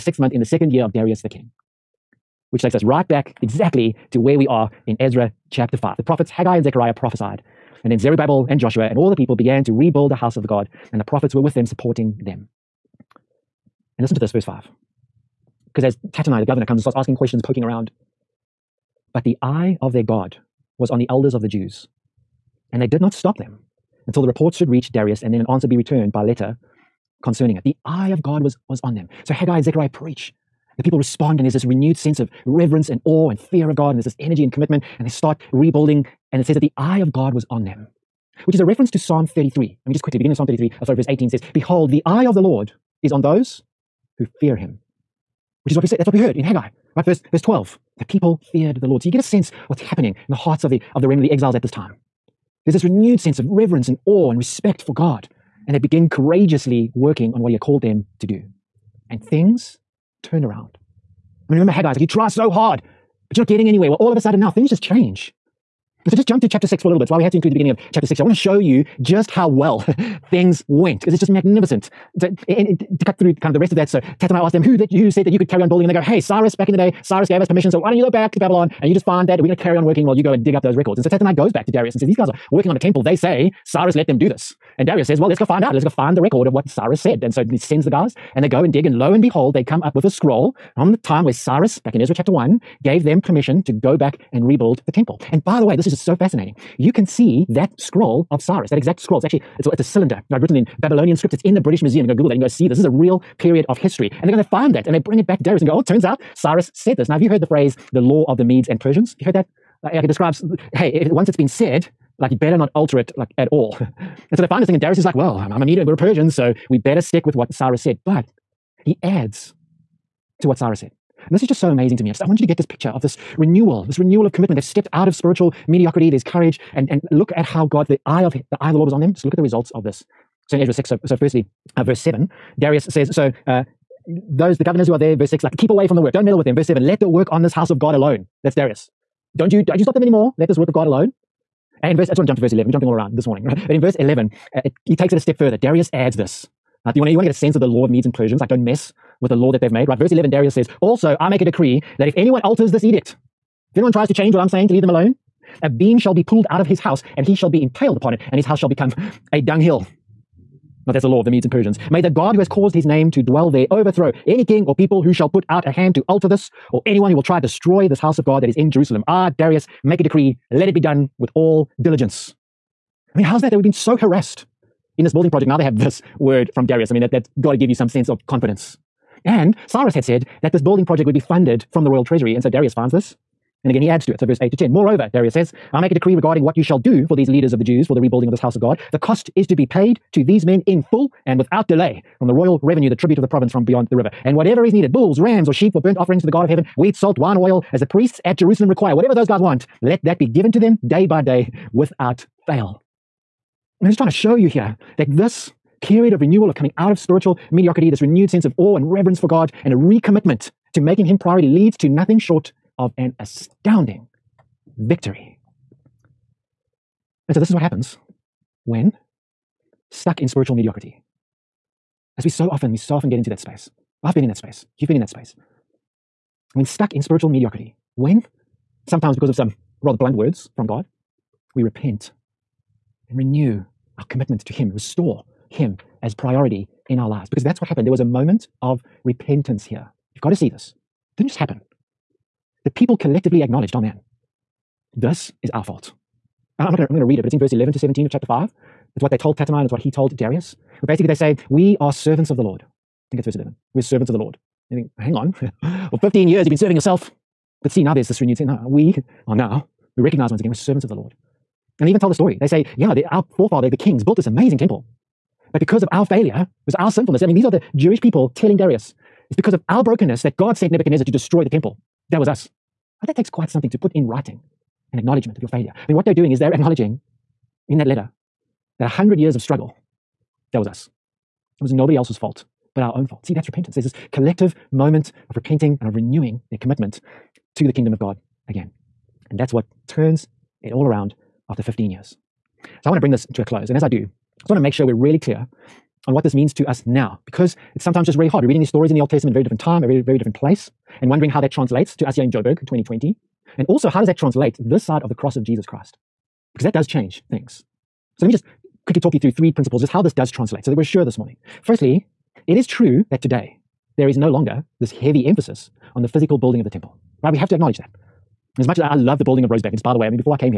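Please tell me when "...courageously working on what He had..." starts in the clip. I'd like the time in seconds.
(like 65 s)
56 s.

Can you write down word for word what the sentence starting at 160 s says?
Now, that's the law of the Medes and Persians.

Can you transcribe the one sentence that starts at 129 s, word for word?
Just look at the results of this.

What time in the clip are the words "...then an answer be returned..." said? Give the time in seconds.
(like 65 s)
25 s.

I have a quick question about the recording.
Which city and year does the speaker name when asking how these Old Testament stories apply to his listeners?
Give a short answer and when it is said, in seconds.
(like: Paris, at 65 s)
Joburg, 2020, at 302 s.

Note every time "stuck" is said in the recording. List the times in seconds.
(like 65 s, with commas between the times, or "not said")
219 s, 226 s.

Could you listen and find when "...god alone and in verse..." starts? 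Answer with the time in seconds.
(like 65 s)
140 s.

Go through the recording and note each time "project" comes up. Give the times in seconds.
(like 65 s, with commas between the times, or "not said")
175 s, 180 s.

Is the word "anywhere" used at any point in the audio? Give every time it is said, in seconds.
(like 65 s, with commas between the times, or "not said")
63 s.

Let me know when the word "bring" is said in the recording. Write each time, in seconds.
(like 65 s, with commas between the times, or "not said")
104 s, 292 s.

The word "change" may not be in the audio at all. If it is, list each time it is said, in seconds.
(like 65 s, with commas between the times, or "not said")
64 s, 154 s, 306 s.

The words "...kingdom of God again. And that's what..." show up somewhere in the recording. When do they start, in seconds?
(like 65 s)
287 s.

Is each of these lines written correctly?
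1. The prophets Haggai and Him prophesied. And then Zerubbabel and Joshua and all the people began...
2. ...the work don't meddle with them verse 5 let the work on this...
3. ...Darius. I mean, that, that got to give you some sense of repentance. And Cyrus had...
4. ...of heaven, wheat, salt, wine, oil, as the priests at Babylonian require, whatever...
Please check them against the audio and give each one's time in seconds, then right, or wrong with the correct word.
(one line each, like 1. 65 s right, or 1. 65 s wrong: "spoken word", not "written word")
1. 5 s wrong: "Zechariah", not "Him"
2. 135 s wrong: "7", not "5"
3. 176 s wrong: "confidence", not "repentance"
4. 196 s wrong: "Jerusalem", not "Babylonian".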